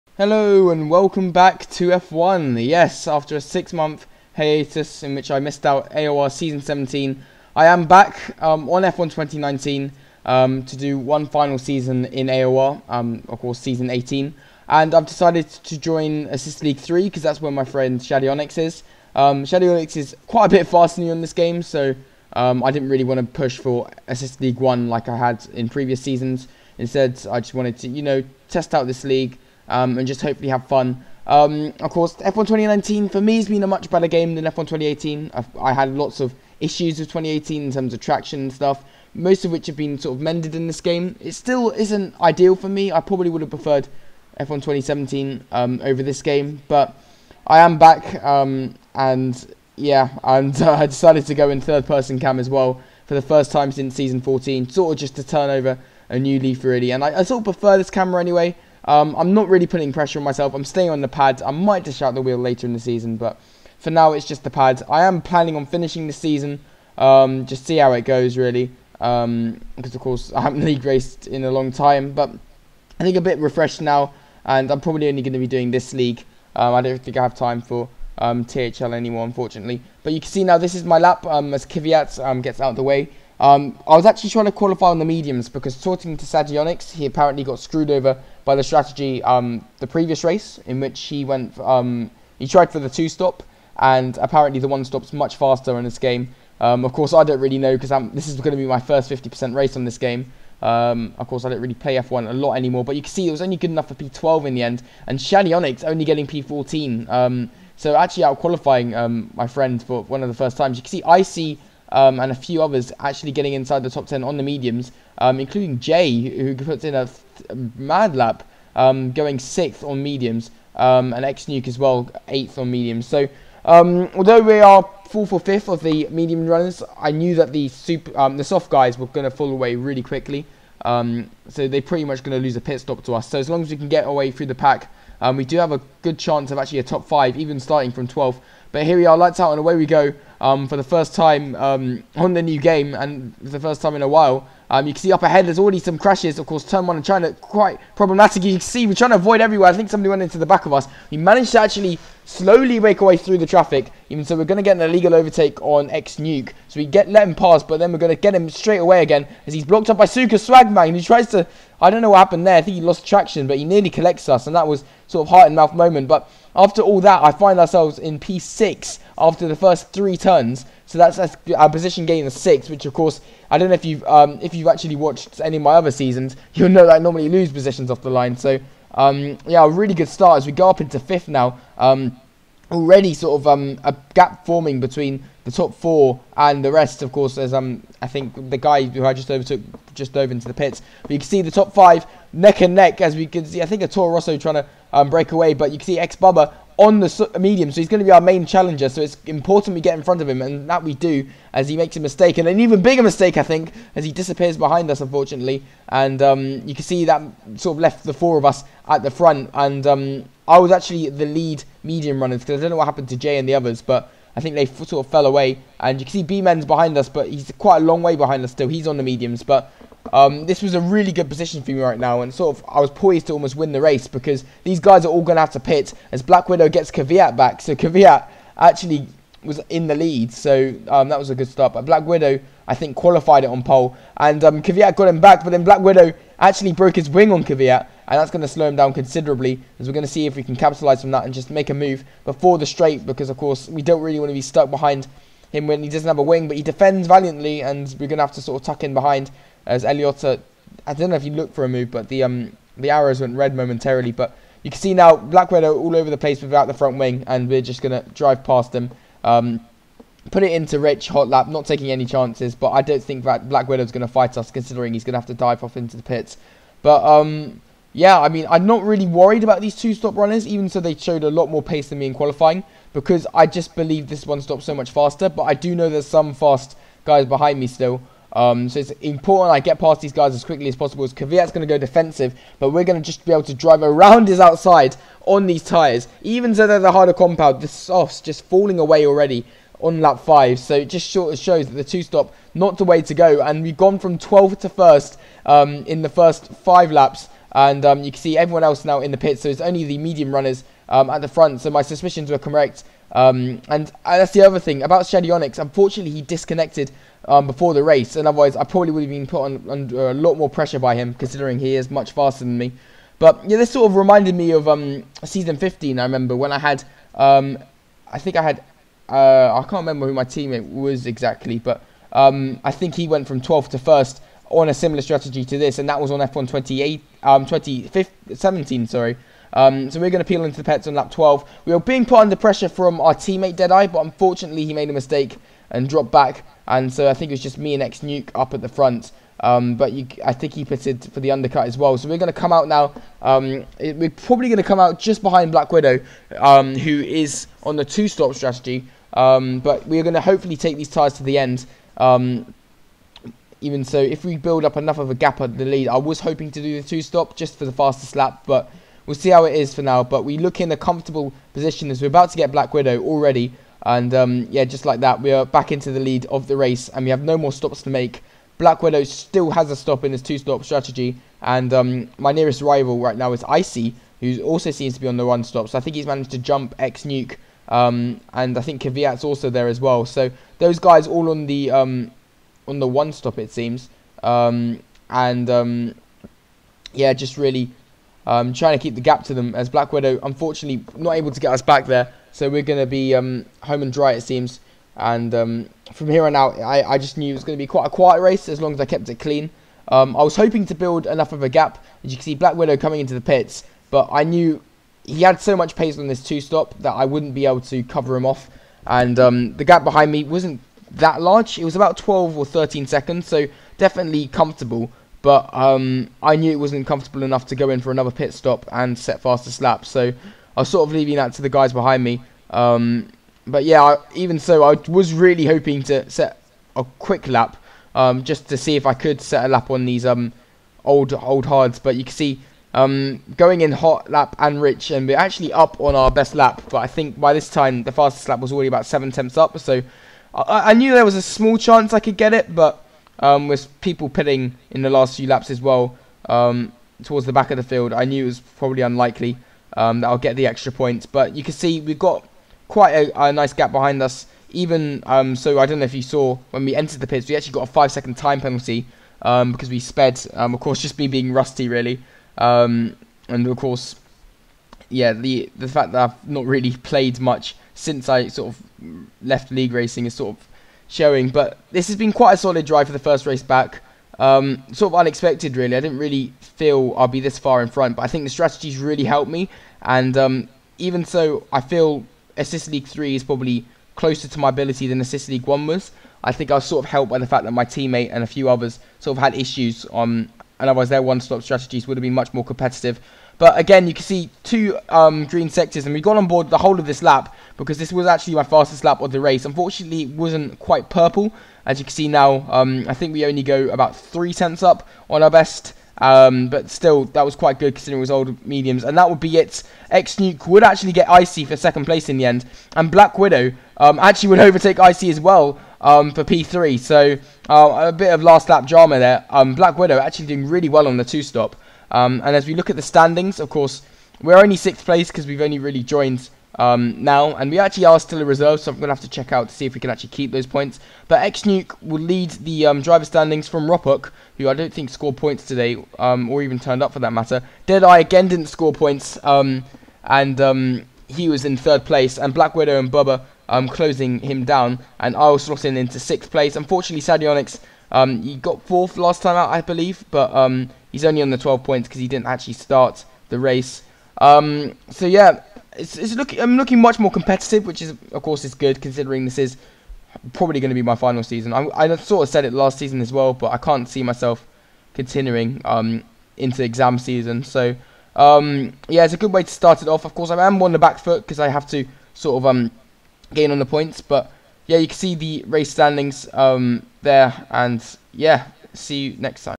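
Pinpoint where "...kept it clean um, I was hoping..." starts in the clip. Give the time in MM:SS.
06:38.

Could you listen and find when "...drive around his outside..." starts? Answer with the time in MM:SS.
04:43.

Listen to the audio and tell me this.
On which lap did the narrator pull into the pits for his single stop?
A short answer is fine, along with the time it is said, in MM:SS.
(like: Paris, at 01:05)
Lap 12, at 05:30.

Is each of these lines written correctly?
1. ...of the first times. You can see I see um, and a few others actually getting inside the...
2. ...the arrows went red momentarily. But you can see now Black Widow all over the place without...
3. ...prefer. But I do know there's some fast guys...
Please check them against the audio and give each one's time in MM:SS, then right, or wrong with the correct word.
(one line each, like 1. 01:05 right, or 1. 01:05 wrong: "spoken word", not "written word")
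1. 01:50 right
2. 04:12 right
3. 04:34 wrong: "faster", not "prefer".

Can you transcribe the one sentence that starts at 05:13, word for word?
But yeah, this sort of reminded me of um, season 15.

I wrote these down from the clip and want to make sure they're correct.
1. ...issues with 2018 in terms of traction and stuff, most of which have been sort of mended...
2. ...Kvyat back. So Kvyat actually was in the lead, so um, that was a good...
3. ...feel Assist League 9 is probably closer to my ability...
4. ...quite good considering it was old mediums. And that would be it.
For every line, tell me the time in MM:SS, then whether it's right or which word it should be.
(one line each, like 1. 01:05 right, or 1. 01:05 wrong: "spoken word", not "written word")
1. 00:36 right
2. 03:46 right
3. 08:01 wrong: "3", not "9"
4. 08:27 right.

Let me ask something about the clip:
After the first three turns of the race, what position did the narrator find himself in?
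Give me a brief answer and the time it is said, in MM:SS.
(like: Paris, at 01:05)
P6, at 02:48.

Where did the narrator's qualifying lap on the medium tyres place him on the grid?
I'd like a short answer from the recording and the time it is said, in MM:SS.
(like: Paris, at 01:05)
P12, at 01:43.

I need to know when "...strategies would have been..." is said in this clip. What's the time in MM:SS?
08:11.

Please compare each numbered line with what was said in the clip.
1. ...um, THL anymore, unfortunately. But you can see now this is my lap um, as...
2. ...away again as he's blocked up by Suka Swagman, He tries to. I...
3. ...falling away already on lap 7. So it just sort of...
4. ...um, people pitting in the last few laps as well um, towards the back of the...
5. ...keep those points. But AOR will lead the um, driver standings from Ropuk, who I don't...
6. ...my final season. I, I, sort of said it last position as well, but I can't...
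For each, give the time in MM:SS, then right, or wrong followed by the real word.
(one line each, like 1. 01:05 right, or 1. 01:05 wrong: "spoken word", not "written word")
1. 01:18 right
2. 02:38 right
3. 04:48 wrong: "5", not "7"
4. 07:23 right
5. 08:50 wrong: "Xnuke", not "AOR"
6. 09:20 wrong: "season", not "position".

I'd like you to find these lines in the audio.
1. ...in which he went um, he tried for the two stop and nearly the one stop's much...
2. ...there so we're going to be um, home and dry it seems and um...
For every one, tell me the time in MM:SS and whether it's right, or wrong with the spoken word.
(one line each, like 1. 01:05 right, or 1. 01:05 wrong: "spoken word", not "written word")
1. 01:30 wrong: "apparently", not "nearly"
2. 06:31 right.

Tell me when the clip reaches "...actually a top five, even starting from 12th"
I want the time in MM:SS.
02:16.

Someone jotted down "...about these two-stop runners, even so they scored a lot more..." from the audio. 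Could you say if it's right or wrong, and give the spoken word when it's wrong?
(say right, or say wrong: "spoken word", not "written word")
wrong: "showed", not "scored".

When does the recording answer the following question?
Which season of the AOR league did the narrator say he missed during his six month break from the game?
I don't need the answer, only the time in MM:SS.
00:05.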